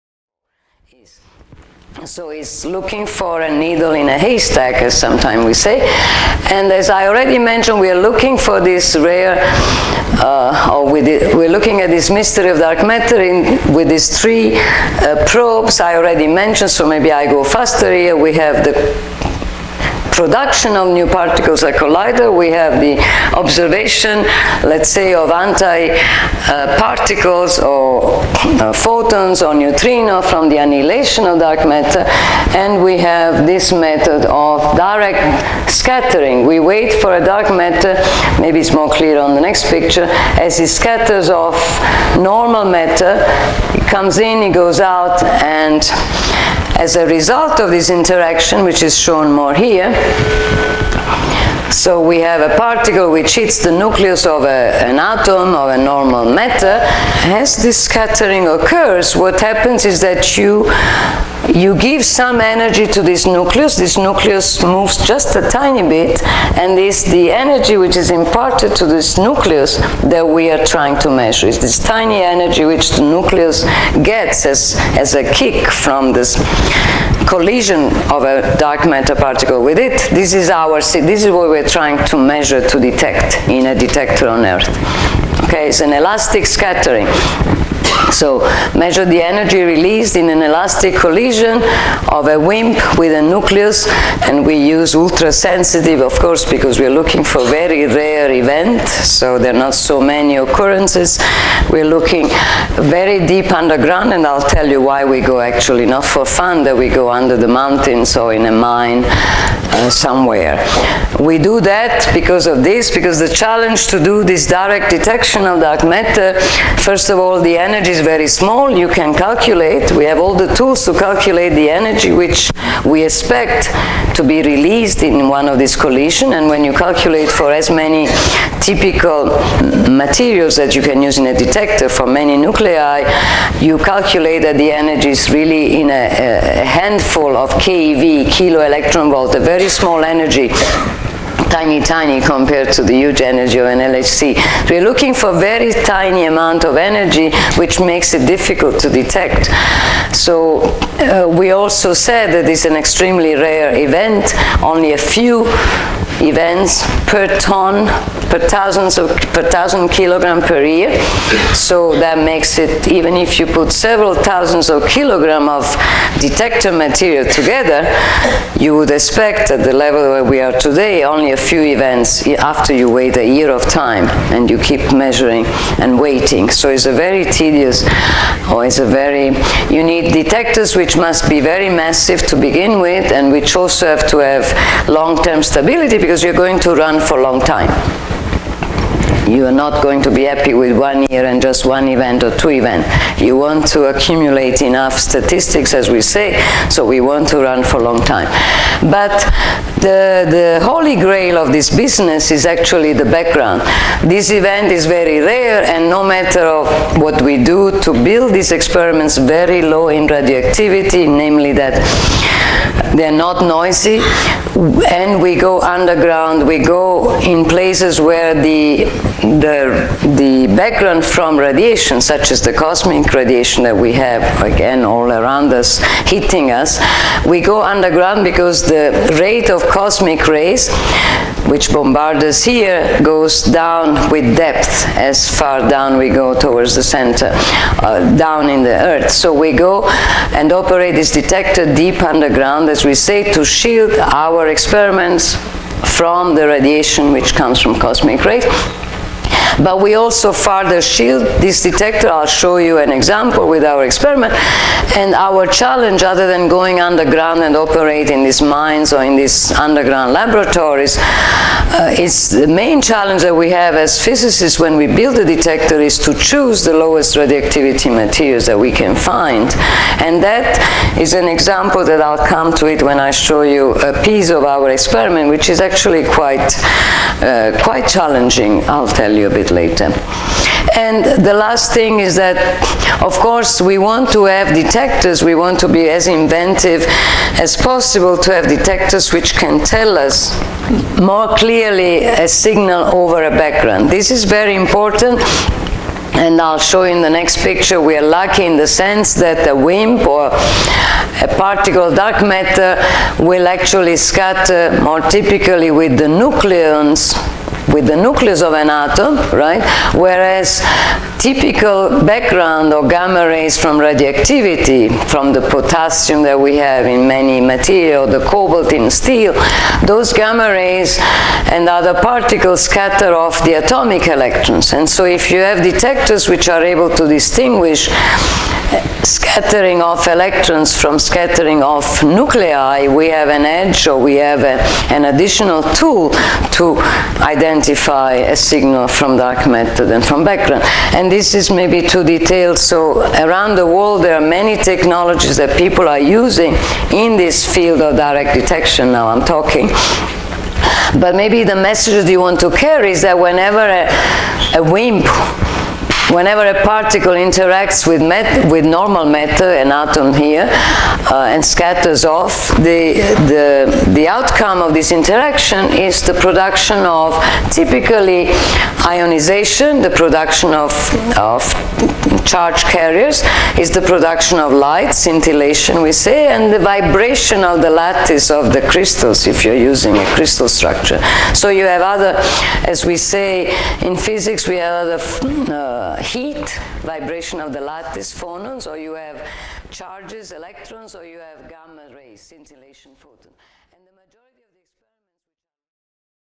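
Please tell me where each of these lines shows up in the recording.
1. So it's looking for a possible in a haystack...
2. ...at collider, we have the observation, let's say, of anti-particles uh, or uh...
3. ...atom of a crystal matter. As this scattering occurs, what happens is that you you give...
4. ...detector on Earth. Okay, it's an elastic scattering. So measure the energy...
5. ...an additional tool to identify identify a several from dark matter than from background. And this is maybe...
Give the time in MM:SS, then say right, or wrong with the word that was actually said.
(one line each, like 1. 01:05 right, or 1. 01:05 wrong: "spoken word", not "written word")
1. 00:02 wrong: "needle", not "possible"
2. 00:21 right
3. 00:54 wrong: "normal", not "crystal"
4. 01:23 right
5. 05:34 wrong: "signal", not "several".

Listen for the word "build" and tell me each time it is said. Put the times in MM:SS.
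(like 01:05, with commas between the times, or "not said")
03:27, 04:24.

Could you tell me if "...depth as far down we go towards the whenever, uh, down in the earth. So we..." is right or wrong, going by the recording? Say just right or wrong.
wrong.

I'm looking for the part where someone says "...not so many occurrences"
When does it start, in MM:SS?
01:39.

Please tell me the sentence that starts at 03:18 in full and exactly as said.
But the, the holy grail of this business is actually the background.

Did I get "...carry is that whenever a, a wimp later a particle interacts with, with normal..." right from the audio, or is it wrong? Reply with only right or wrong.
wrong.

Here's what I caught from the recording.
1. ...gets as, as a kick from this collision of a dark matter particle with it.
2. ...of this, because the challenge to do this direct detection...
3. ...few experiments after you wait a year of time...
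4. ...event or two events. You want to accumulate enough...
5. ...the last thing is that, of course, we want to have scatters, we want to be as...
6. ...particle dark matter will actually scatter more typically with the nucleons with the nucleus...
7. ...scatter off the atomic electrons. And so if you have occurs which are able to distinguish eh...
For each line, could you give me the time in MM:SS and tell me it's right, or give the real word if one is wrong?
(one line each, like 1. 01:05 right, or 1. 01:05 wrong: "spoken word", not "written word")
1. 01:14 right
2. 01:52 right
3. 02:51 wrong: "events", not "experiments"
4. 03:11 right
5. 04:41 wrong: "detectors", not "scatters"
6. 05:01 right
7. 05:22 wrong: "detectors", not "occurs".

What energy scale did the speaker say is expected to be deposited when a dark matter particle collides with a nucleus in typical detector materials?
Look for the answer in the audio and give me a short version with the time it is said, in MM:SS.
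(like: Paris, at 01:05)
a handful of keV, at 02:16.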